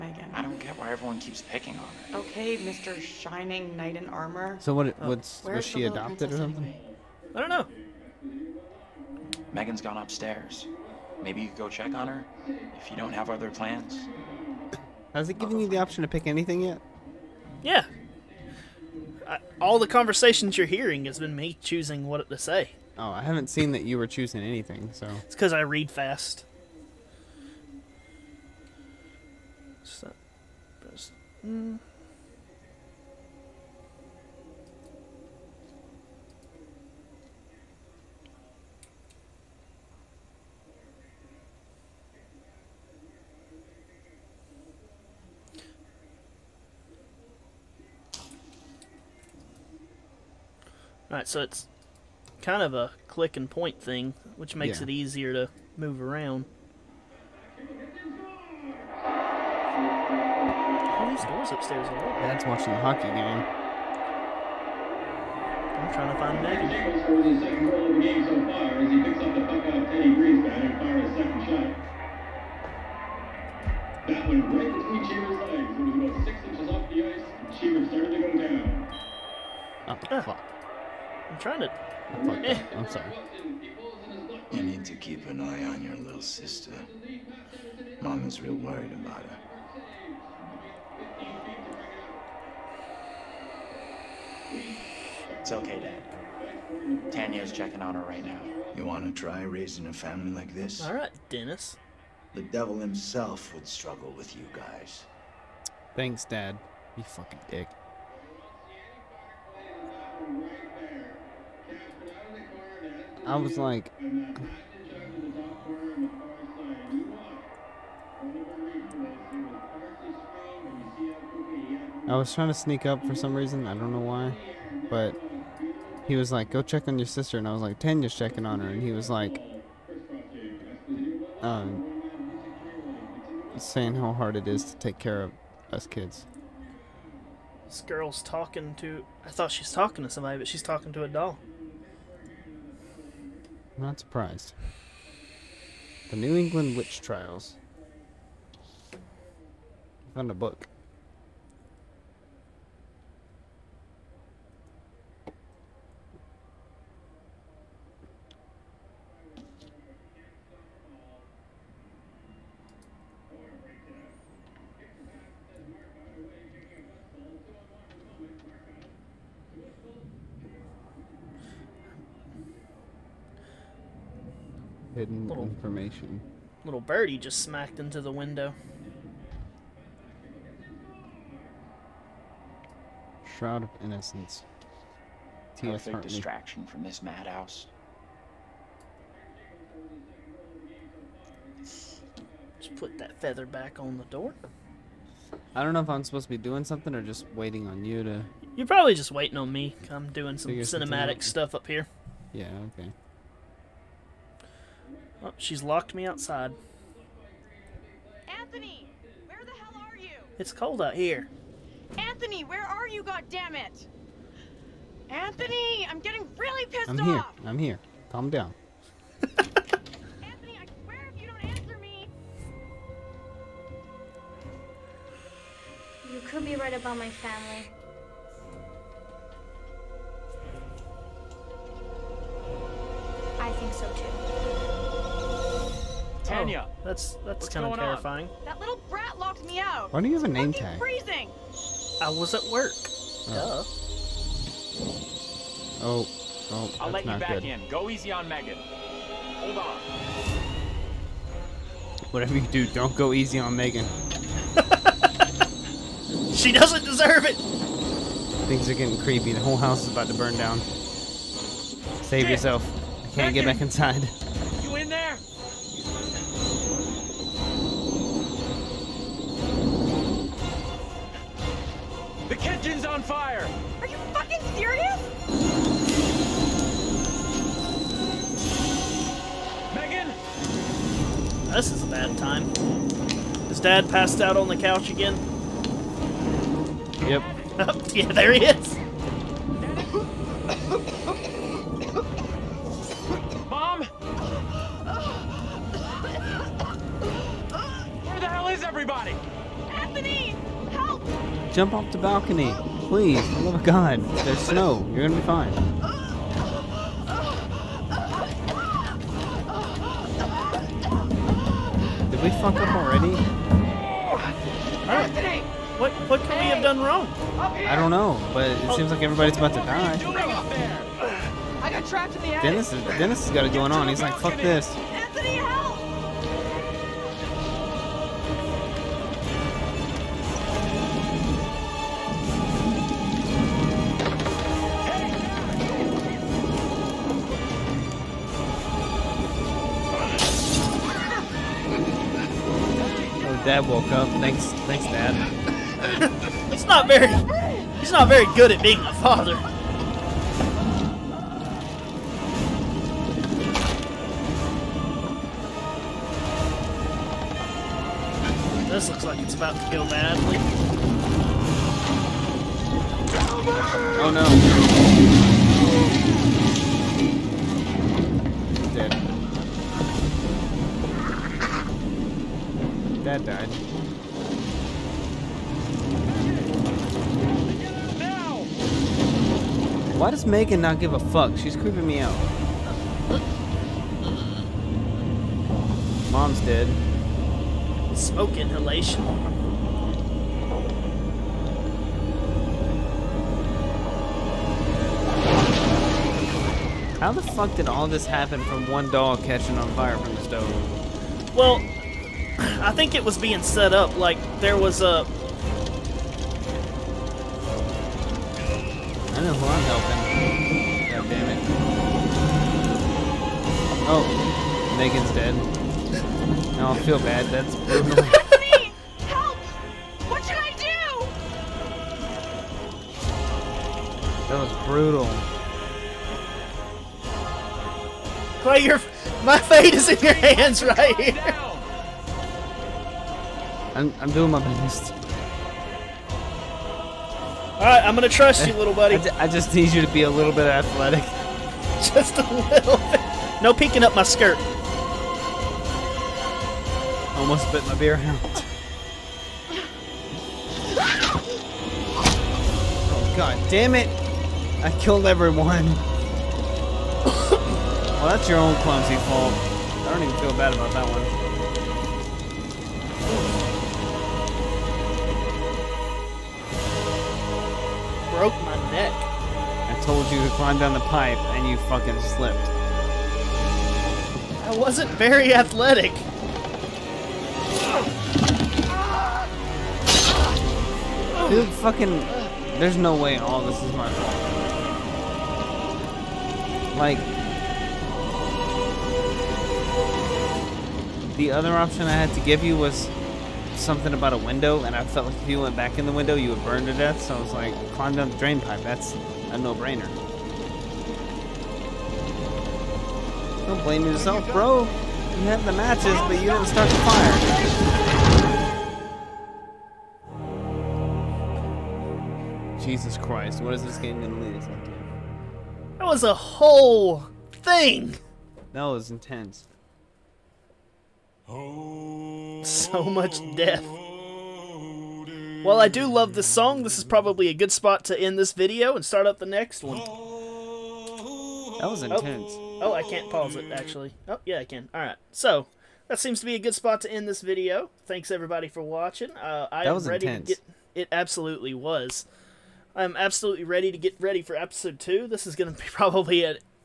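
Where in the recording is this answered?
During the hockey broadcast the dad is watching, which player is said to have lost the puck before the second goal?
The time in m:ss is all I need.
1:09.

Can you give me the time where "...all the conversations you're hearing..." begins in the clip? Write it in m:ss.
0:19.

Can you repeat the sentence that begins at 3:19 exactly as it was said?
I'm doing some cinematic stuff up here.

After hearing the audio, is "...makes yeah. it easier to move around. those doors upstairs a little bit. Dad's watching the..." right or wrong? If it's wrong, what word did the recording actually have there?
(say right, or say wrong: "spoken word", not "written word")
right.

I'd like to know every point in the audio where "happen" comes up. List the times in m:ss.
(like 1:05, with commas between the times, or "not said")
6:38.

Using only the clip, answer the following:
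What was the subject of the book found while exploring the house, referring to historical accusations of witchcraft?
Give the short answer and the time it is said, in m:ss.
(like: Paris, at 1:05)
The New England Witch Trials, at 2:26.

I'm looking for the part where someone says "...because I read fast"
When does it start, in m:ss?
0:25.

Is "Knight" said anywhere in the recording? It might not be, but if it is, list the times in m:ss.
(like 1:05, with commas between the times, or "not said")
0:03.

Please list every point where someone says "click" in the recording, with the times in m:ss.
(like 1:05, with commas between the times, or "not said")
0:53.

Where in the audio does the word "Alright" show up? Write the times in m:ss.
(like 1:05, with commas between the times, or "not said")
8:54.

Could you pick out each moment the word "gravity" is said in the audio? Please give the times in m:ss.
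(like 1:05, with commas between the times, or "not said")
not said.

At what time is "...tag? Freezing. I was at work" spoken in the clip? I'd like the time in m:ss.
4:00.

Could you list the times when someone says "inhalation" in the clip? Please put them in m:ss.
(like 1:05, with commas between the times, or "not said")
6:28.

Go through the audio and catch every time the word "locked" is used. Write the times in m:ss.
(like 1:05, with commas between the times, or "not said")
3:25, 3:59.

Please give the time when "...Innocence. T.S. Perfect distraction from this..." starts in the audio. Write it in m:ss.
3:03.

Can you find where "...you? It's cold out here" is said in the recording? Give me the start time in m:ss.
3:29.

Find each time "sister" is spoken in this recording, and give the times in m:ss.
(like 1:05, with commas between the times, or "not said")
1:26, 2:07.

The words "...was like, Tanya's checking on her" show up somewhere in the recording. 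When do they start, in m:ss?
2:07.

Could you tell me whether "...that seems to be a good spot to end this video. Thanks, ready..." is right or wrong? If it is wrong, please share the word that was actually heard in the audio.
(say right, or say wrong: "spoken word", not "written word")
wrong: "everybody", not "ready".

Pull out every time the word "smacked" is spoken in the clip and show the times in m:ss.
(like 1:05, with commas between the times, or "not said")
2:57.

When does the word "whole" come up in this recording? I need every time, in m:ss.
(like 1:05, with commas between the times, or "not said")
4:19, 8:36.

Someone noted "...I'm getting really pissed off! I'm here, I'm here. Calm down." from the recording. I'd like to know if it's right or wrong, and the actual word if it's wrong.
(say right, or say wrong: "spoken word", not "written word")
right.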